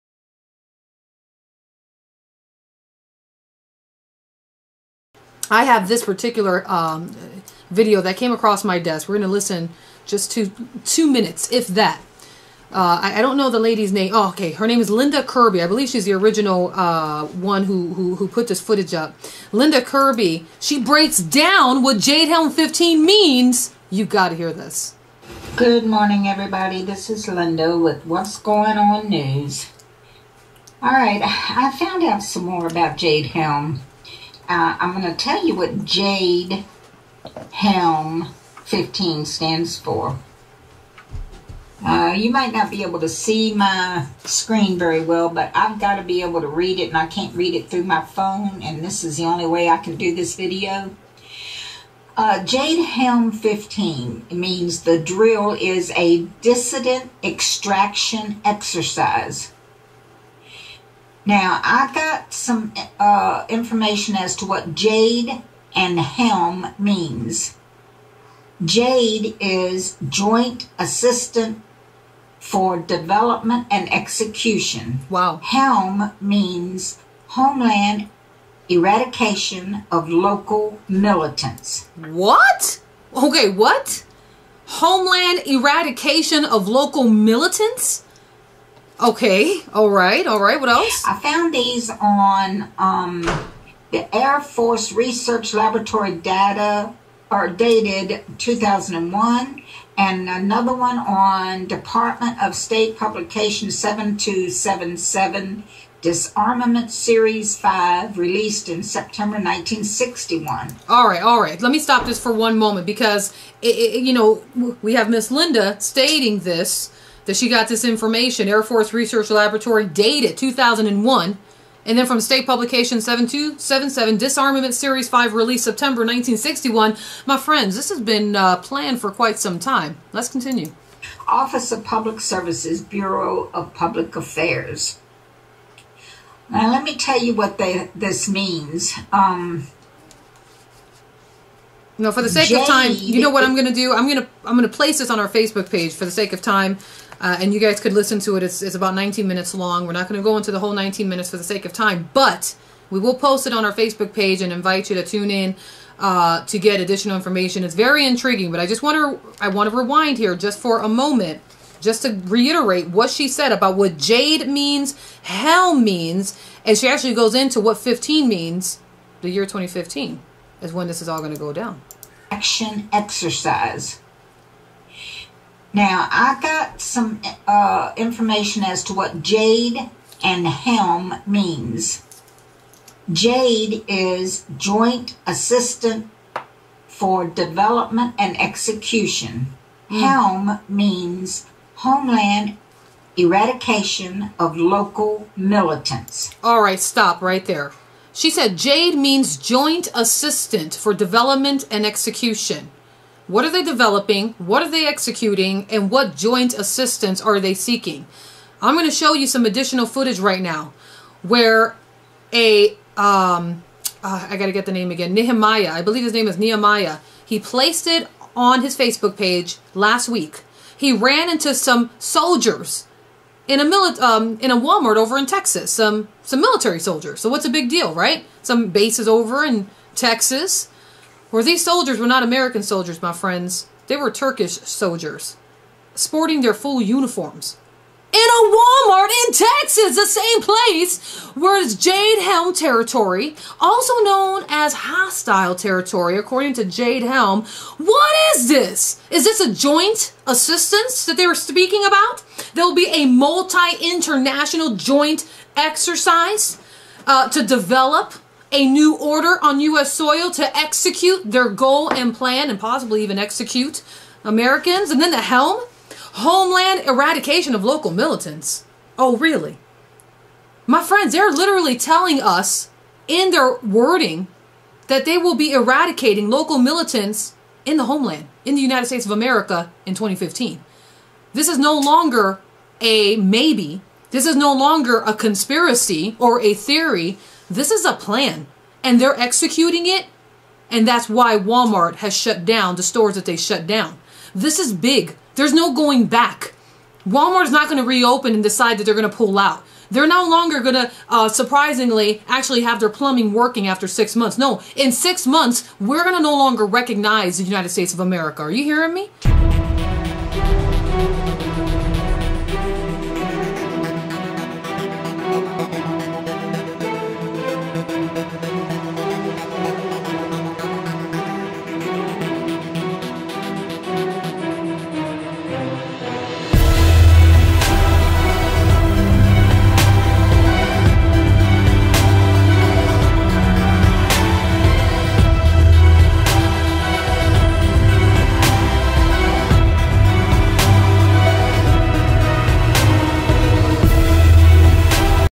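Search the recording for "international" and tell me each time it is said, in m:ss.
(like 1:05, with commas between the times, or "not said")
4:13.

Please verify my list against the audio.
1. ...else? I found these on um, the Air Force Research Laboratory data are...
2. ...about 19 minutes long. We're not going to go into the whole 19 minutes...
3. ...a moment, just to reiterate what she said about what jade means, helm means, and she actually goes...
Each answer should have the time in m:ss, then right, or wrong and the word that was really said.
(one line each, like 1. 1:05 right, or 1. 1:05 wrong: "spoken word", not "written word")
1. 1:30 right
2. 2:28 right
3. 2:40 right.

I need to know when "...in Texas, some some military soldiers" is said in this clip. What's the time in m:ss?
3:45.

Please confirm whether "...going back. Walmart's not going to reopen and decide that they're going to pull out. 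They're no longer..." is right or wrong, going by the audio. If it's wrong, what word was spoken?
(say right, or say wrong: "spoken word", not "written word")
right.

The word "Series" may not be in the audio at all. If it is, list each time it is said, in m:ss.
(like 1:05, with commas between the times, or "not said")
1:46, 2:04.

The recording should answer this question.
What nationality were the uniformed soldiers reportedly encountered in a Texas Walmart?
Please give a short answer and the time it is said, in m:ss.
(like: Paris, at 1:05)
Turkish, at 3:54.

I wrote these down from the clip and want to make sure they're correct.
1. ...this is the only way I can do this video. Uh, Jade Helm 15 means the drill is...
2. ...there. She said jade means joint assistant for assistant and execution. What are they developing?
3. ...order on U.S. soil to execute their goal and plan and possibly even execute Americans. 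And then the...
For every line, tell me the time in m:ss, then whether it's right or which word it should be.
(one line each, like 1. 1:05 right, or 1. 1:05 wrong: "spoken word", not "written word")
1. 0:48 right
2. 3:17 wrong: "development", not "assistant"
3. 4:18 right.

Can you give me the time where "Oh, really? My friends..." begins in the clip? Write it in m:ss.
4:28.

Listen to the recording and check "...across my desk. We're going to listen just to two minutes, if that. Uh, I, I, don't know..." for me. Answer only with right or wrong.
right.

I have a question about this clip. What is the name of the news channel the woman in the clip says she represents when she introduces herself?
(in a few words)
What's Going On News.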